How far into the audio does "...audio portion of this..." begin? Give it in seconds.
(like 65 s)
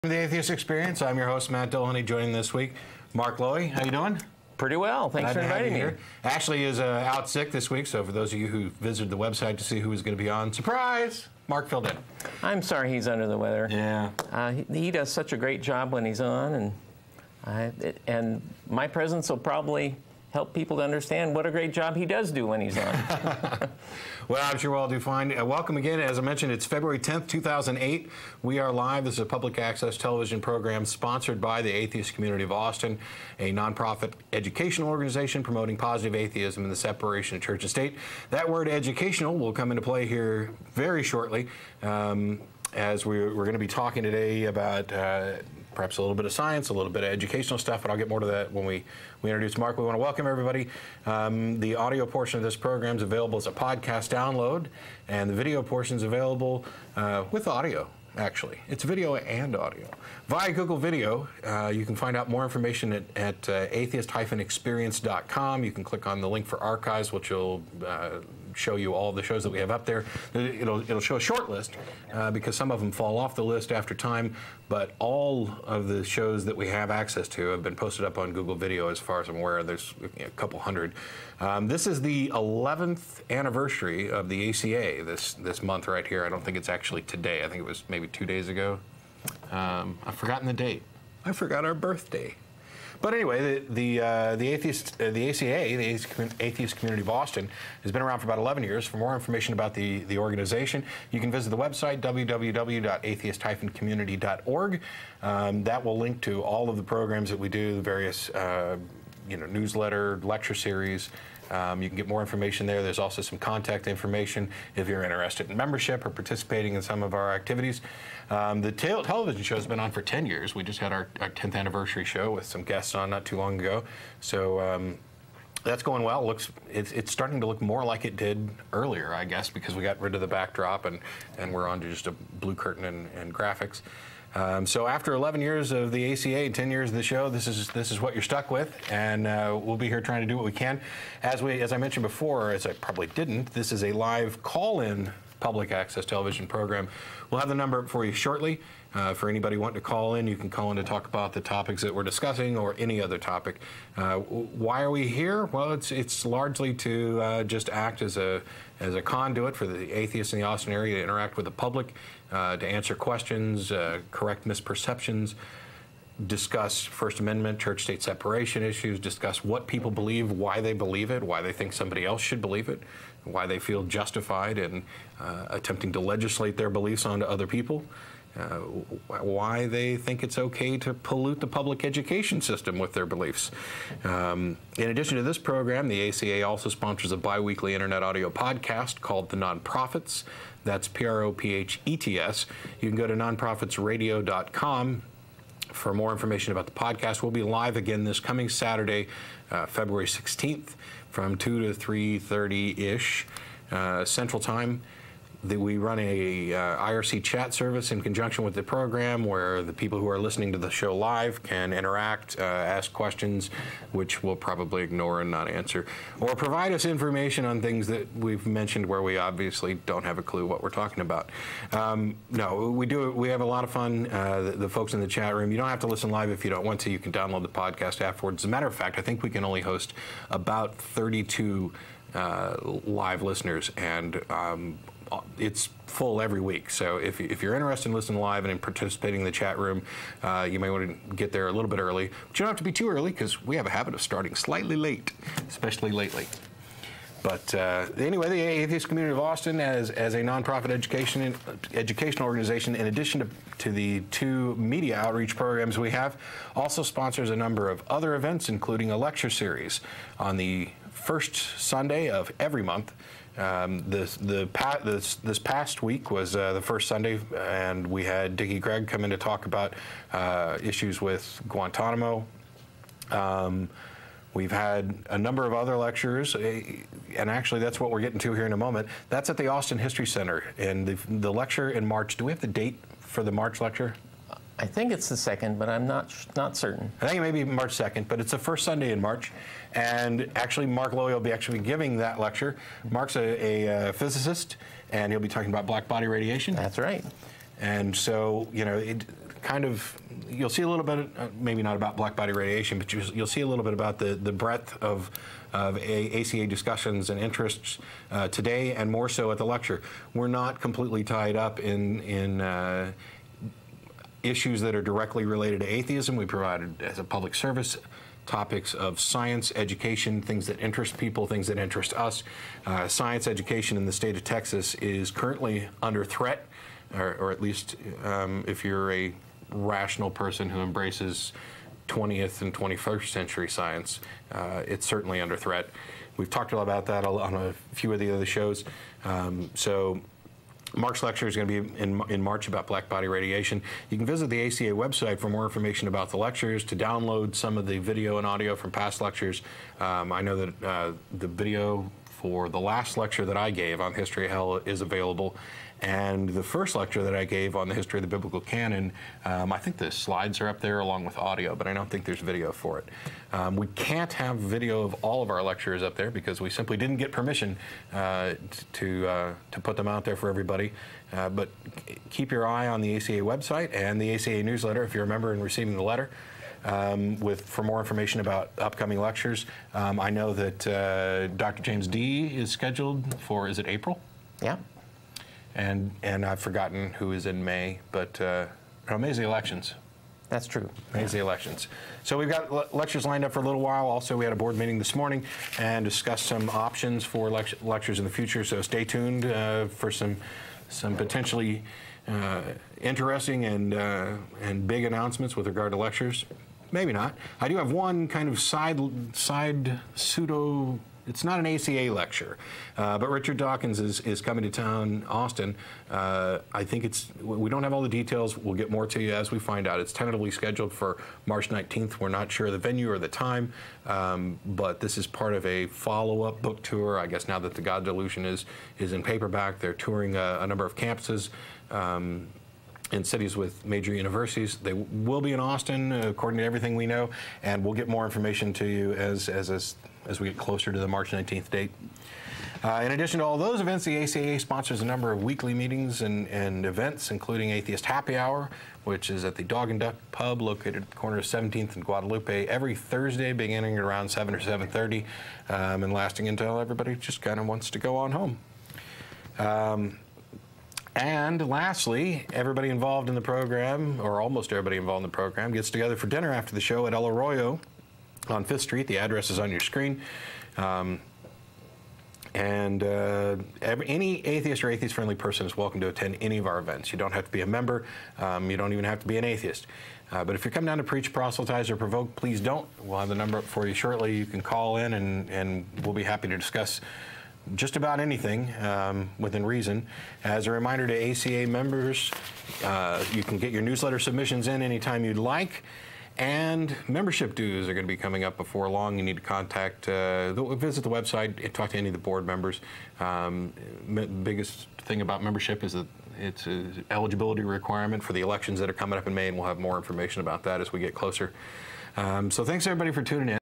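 51 s.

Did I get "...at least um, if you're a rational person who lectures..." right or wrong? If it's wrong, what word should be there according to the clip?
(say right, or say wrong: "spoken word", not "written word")
wrong: "embraces", not "lectures".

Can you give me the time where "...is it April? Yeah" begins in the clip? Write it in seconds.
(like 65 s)
383 s.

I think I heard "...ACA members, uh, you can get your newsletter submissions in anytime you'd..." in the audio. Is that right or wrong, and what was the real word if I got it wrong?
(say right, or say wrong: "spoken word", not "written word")
right.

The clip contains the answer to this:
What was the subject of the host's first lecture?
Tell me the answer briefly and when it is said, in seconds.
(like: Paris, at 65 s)
history of the biblical canon, at 357 s.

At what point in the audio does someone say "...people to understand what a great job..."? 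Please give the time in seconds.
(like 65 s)
20 s.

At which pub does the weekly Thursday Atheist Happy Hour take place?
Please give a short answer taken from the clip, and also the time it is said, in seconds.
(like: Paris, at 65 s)
Dog and Duck Pub, at 449 s.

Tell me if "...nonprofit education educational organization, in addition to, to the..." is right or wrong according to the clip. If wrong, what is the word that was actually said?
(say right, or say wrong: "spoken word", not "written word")
right.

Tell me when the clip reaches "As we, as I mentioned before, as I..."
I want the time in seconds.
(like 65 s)
141 s.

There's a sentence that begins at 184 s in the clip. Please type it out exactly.
Um, in addition to this program, the ACA also sponsors a biweekly internet audio podcast called The Non-Prophets.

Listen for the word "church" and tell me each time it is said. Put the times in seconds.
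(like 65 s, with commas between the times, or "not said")
37 s, 167 s.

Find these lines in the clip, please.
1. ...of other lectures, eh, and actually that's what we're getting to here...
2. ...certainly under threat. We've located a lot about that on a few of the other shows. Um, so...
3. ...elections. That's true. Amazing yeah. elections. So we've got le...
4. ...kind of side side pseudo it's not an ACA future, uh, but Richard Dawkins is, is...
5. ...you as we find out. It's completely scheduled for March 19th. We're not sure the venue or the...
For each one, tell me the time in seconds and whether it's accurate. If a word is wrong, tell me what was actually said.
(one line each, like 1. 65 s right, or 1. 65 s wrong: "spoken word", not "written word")
1. 275 s right
2. 334 s wrong: "talked", not "located"
3. 389 s right
4. 408 s wrong: "lecture", not "future"
5. 419 s wrong: "tentatively", not "completely".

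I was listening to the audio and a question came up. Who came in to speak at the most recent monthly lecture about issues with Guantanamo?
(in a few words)
Dickie Gregg.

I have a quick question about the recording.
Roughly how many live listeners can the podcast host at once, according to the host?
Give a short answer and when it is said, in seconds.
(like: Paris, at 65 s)
32, at 230 s.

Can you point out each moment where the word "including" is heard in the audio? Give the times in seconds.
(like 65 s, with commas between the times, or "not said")
258 s, 447 s.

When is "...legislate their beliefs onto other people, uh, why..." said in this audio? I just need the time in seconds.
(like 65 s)
175 s.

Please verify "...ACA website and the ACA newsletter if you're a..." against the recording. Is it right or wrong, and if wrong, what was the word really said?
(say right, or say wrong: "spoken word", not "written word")
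right.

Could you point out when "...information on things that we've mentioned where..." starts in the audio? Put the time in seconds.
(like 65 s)
216 s.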